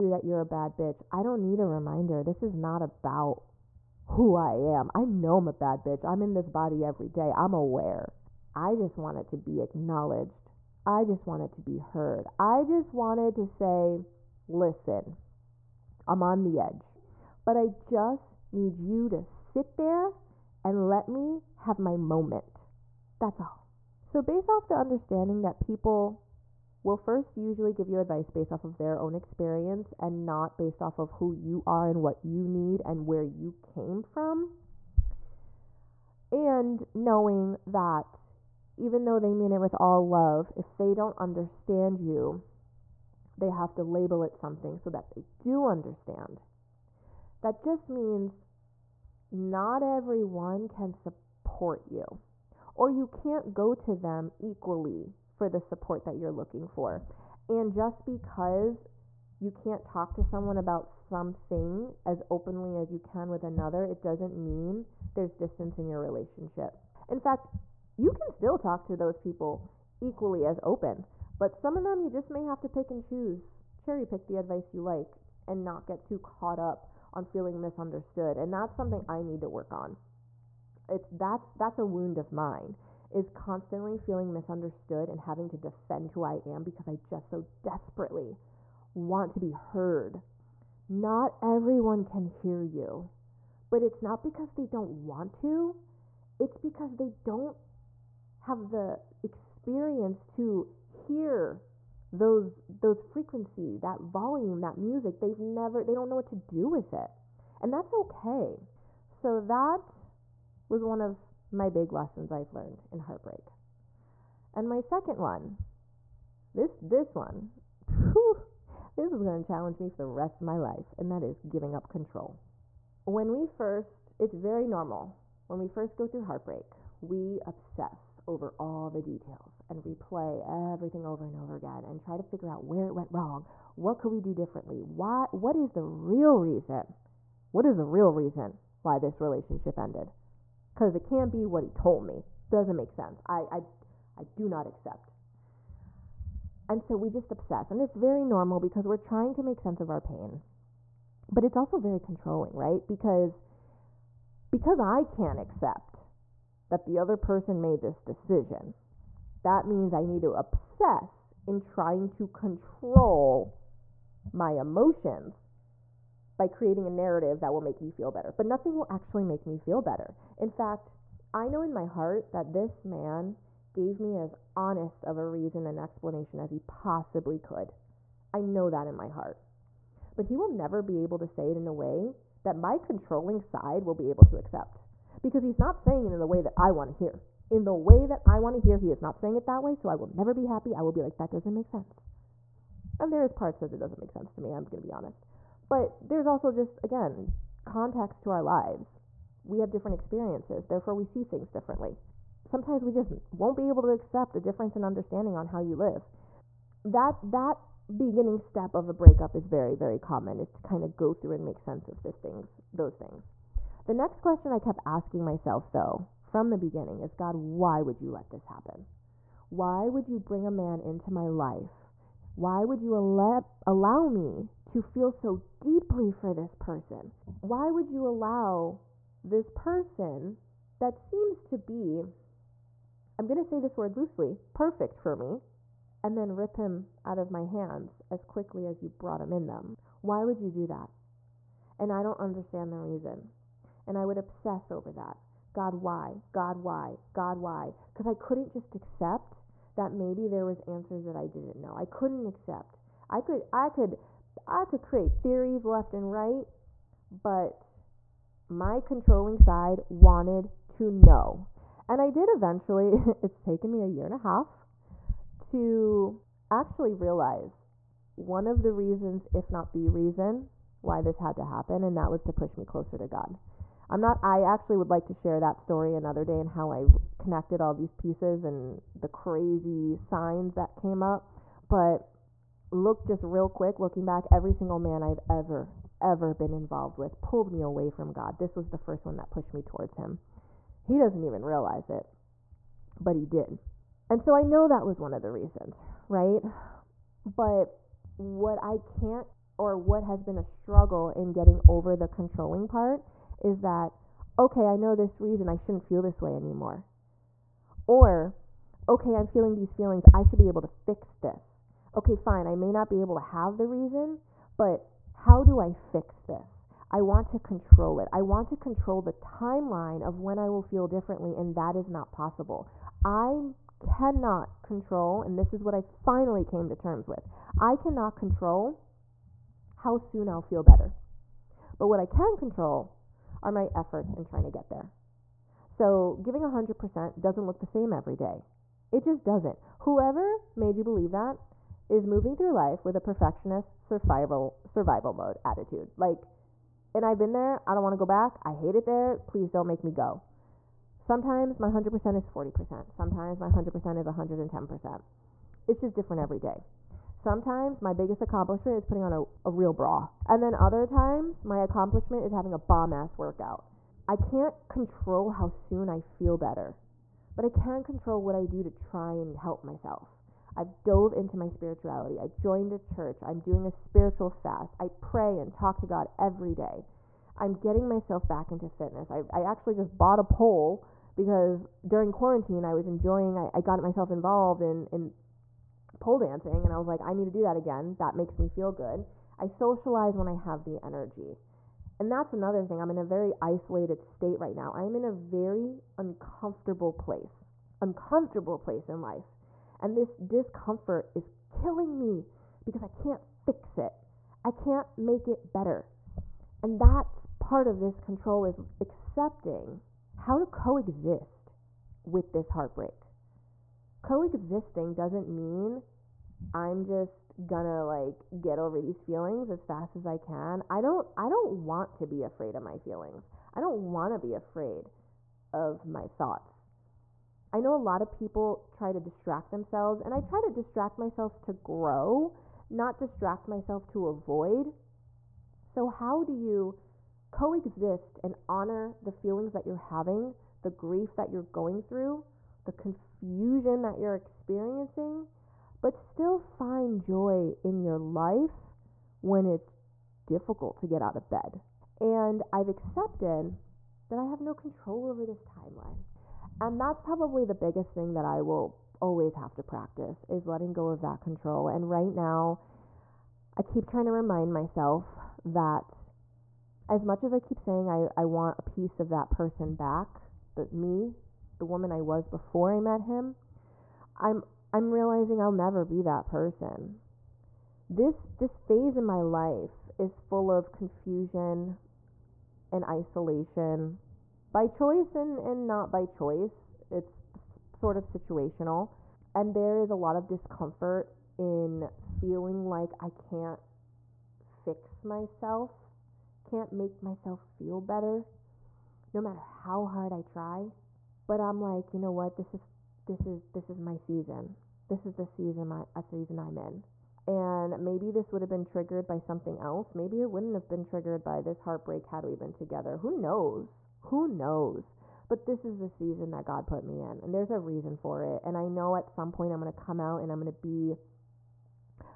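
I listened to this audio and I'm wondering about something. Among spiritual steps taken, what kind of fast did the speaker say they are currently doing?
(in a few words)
spiritual fast.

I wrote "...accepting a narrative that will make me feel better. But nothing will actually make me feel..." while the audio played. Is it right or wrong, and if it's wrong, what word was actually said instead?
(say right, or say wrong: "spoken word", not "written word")
wrong: "creating", not "accepting".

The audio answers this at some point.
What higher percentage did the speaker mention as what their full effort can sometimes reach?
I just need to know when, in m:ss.
5:54.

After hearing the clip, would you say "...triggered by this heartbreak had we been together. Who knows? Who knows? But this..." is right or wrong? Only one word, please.
right.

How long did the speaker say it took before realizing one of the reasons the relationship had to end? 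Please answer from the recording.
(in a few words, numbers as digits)
a year and a half.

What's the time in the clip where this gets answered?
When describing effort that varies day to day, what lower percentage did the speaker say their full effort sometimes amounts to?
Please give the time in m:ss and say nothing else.
5:52.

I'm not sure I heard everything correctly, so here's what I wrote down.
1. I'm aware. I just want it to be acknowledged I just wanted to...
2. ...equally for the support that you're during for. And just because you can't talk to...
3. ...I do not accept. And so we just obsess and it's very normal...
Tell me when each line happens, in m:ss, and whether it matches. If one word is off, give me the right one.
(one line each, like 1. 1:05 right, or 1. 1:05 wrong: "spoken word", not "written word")
1. 0:07 right
2. 0:54 wrong: "looking", not "during"
3. 2:24 right.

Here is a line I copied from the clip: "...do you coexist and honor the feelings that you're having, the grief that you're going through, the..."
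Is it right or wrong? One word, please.
right.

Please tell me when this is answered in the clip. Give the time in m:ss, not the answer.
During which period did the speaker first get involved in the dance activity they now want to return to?
6:22.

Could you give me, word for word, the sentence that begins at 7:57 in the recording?
This this phase in my life is full of confusion and isolation by choice and, and not by choice.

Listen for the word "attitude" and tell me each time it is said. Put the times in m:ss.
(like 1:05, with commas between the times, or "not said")
5:45.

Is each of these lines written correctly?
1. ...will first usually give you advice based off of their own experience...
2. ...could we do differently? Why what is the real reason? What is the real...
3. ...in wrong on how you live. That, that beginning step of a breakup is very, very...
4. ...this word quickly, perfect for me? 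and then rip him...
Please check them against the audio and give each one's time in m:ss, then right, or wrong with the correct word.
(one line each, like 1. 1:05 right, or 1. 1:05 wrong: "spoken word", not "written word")
1. 0:26 right
2. 2:13 right
3. 3:24 wrong: "understanding", not "wrong"
4. 3:53 wrong: "loosely", not "quickly".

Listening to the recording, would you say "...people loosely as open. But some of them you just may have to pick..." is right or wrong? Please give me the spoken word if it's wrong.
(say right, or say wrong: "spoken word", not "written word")
wrong: "equally", not "loosely".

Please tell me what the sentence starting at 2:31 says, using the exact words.
But it's also very controlling, right?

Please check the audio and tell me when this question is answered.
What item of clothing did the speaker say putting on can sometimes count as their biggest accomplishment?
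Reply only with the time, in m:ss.
5:59.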